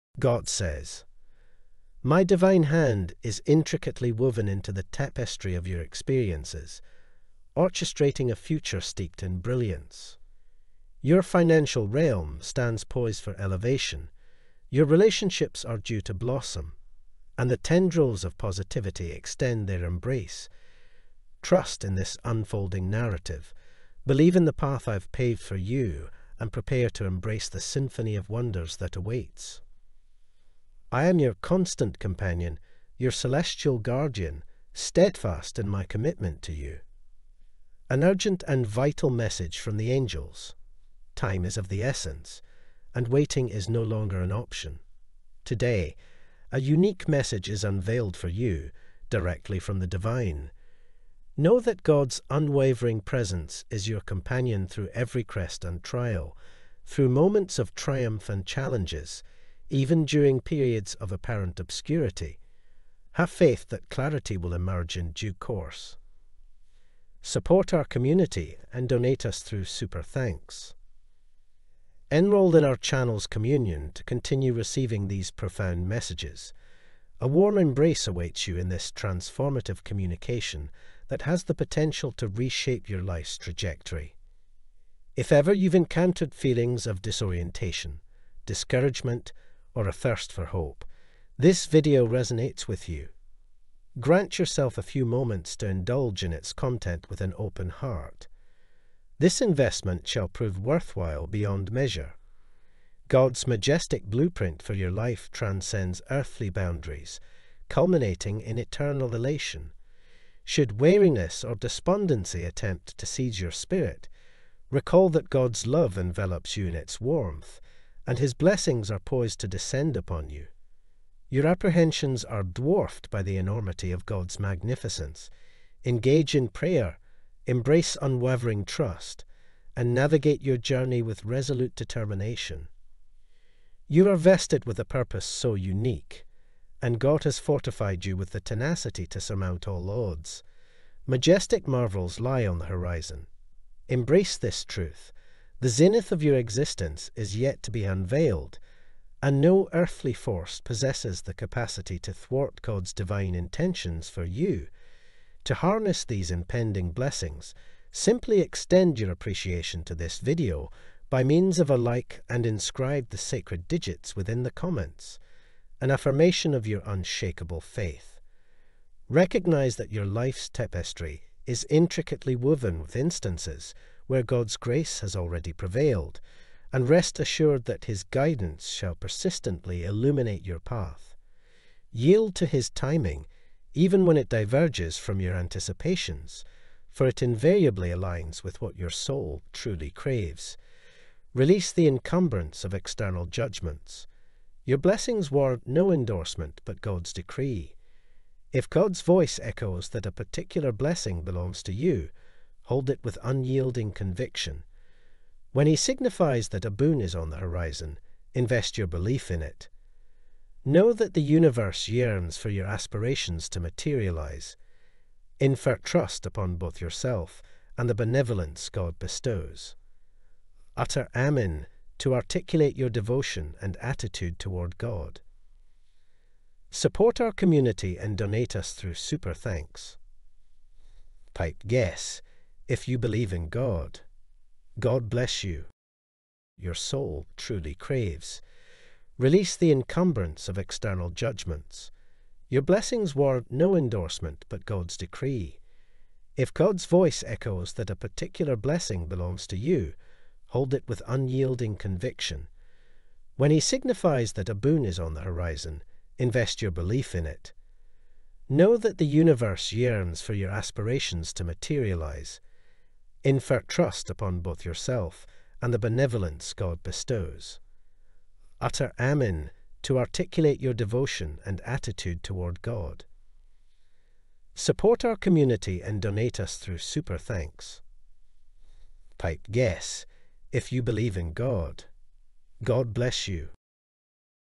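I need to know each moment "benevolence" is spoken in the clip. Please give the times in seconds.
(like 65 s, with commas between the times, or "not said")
218 s, 265 s.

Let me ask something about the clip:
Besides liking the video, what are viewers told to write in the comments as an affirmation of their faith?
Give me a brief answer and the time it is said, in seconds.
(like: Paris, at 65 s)
the sacred digits, at 163 s.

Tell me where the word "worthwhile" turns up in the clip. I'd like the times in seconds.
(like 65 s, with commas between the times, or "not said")
100 s.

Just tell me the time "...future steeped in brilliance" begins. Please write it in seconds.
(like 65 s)
8 s.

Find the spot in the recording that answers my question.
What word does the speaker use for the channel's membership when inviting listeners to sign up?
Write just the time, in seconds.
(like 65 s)
73 s.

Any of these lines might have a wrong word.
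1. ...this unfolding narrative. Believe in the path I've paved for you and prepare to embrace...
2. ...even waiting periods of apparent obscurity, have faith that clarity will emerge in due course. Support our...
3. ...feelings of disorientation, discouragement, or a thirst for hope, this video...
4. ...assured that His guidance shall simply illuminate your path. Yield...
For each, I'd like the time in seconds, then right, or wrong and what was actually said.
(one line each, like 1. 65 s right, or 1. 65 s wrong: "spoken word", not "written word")
1. 21 s right
2. 59 s wrong: "during", not "waiting"
3. 86 s right
4. 177 s wrong: "persistently", not "simply".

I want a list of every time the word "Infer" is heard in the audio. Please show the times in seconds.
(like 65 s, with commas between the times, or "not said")
215 s, 263 s.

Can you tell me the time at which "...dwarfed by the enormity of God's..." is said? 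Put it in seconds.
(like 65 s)
122 s.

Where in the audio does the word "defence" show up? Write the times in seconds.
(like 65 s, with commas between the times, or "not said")
not said.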